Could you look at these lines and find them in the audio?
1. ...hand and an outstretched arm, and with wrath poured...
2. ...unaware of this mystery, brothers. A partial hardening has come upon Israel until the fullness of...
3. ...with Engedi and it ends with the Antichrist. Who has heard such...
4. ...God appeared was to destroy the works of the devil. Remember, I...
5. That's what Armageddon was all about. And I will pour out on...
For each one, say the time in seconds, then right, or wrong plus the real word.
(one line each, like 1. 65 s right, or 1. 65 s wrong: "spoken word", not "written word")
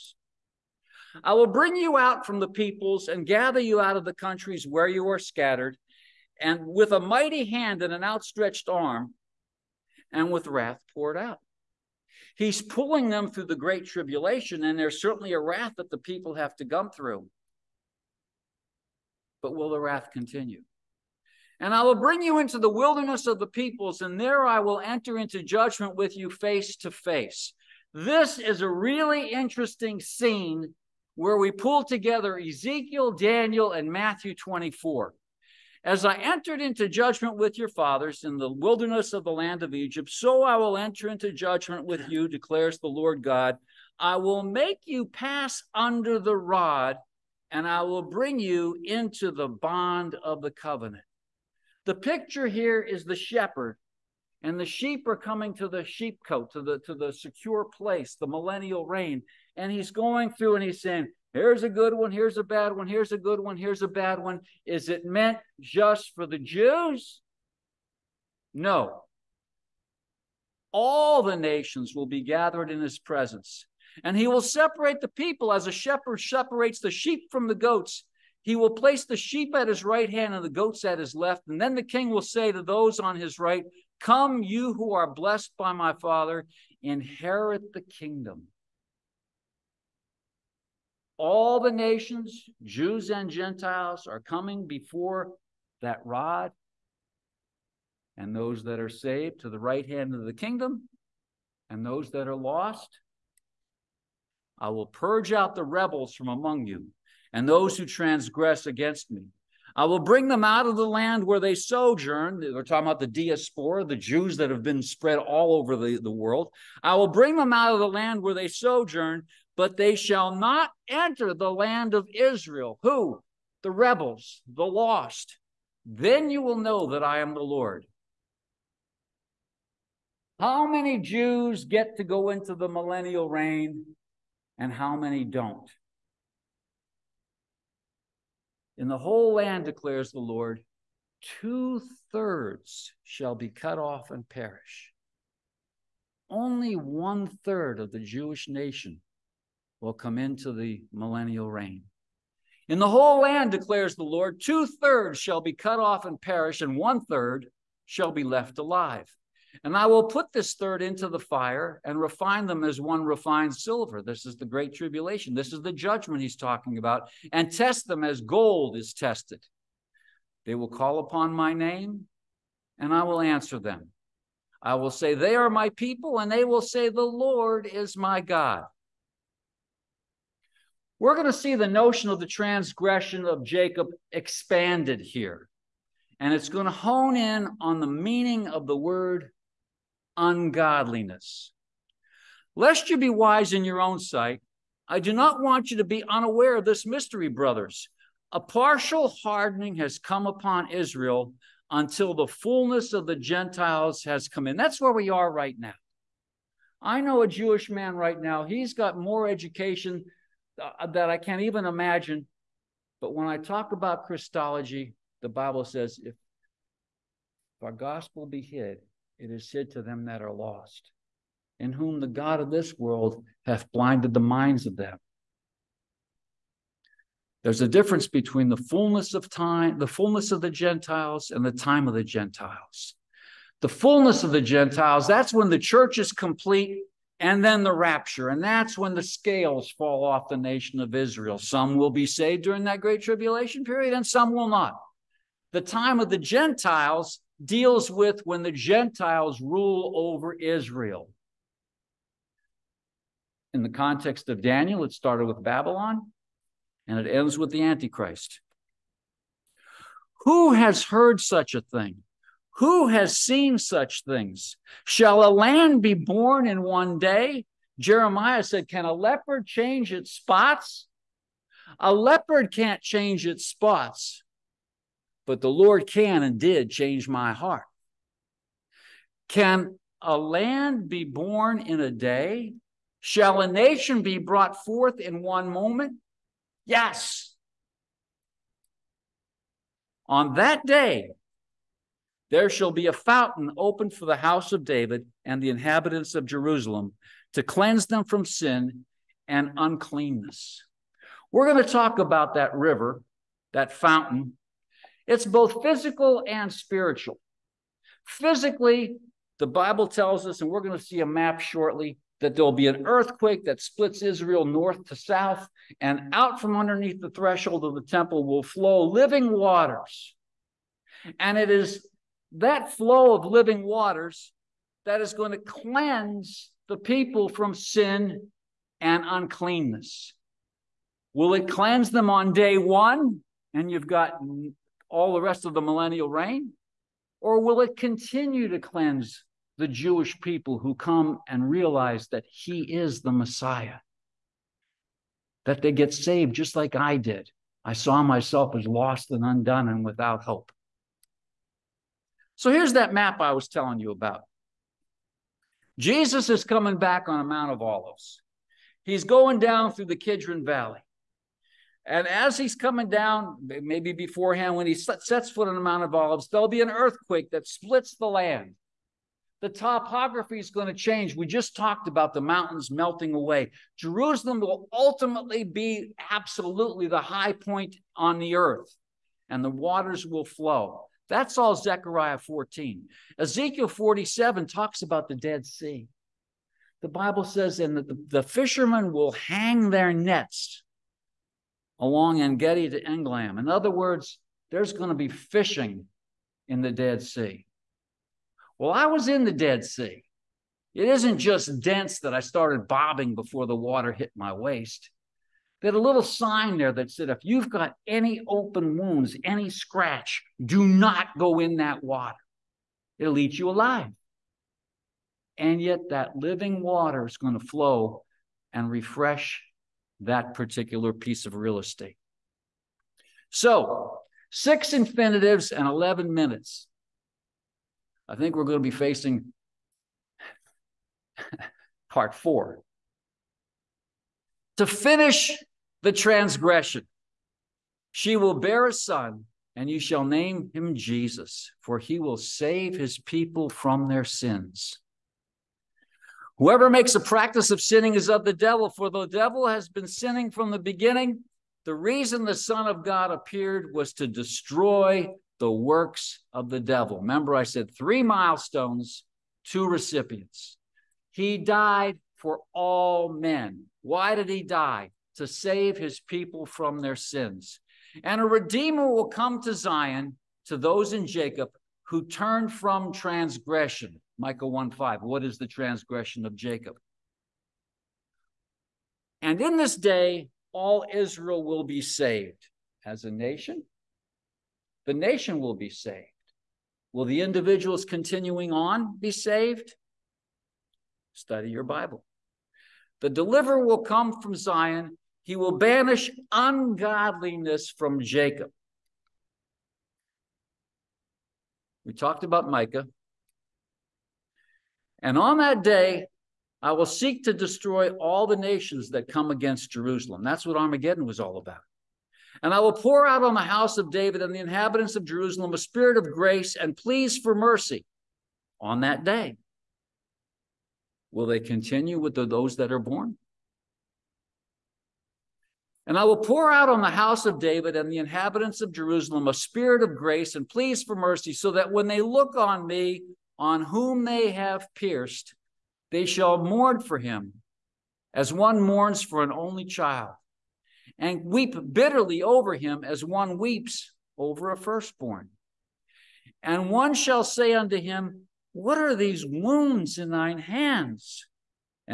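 1. 7 s right
2. 196 s right
3. 255 s wrong: "Babylon", not "Engedi"
4. 452 s right
5. 510 s right.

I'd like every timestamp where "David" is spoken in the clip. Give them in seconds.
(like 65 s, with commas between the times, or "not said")
294 s, 513 s, 527 s.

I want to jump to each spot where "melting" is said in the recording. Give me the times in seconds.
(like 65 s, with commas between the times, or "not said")
372 s.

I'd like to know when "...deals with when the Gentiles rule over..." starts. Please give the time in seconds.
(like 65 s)
247 s.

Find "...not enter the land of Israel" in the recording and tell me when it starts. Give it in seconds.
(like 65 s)
120 s.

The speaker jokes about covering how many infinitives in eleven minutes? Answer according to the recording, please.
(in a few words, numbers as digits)
6.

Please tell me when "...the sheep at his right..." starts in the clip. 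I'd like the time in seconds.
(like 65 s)
79 s.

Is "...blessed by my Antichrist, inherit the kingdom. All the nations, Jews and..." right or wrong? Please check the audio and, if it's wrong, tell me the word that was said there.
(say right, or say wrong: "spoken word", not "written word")
wrong: "Father", not "Antichrist".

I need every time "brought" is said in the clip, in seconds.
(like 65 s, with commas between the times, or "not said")
284 s.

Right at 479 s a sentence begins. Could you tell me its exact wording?
And in this day, all Israel will be saved as a nation.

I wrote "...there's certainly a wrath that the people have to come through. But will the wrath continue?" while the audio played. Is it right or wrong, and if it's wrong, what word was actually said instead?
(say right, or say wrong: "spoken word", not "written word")
right.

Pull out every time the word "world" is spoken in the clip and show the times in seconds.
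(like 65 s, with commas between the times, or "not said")
116 s, 222 s.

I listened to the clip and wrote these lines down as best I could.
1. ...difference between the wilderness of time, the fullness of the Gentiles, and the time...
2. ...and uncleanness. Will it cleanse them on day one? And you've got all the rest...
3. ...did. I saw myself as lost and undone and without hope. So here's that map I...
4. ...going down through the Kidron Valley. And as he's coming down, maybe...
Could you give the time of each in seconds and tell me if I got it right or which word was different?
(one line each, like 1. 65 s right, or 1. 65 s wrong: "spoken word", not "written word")
1. 227 s wrong: "fullness", not "wilderness"
2. 328 s right
3. 346 s right
4. 359 s right.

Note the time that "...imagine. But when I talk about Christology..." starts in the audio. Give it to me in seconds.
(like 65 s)
211 s.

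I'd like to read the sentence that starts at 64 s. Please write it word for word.
Is it meant just for the Jews?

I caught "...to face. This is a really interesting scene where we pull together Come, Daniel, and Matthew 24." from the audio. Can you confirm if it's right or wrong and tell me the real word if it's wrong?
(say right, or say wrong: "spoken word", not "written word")
wrong: "Ezekiel", not "Come".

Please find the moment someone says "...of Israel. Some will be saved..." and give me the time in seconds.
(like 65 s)
240 s.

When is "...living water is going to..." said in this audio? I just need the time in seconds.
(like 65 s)
416 s.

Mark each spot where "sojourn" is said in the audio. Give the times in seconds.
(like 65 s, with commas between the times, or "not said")
111 s, 118 s.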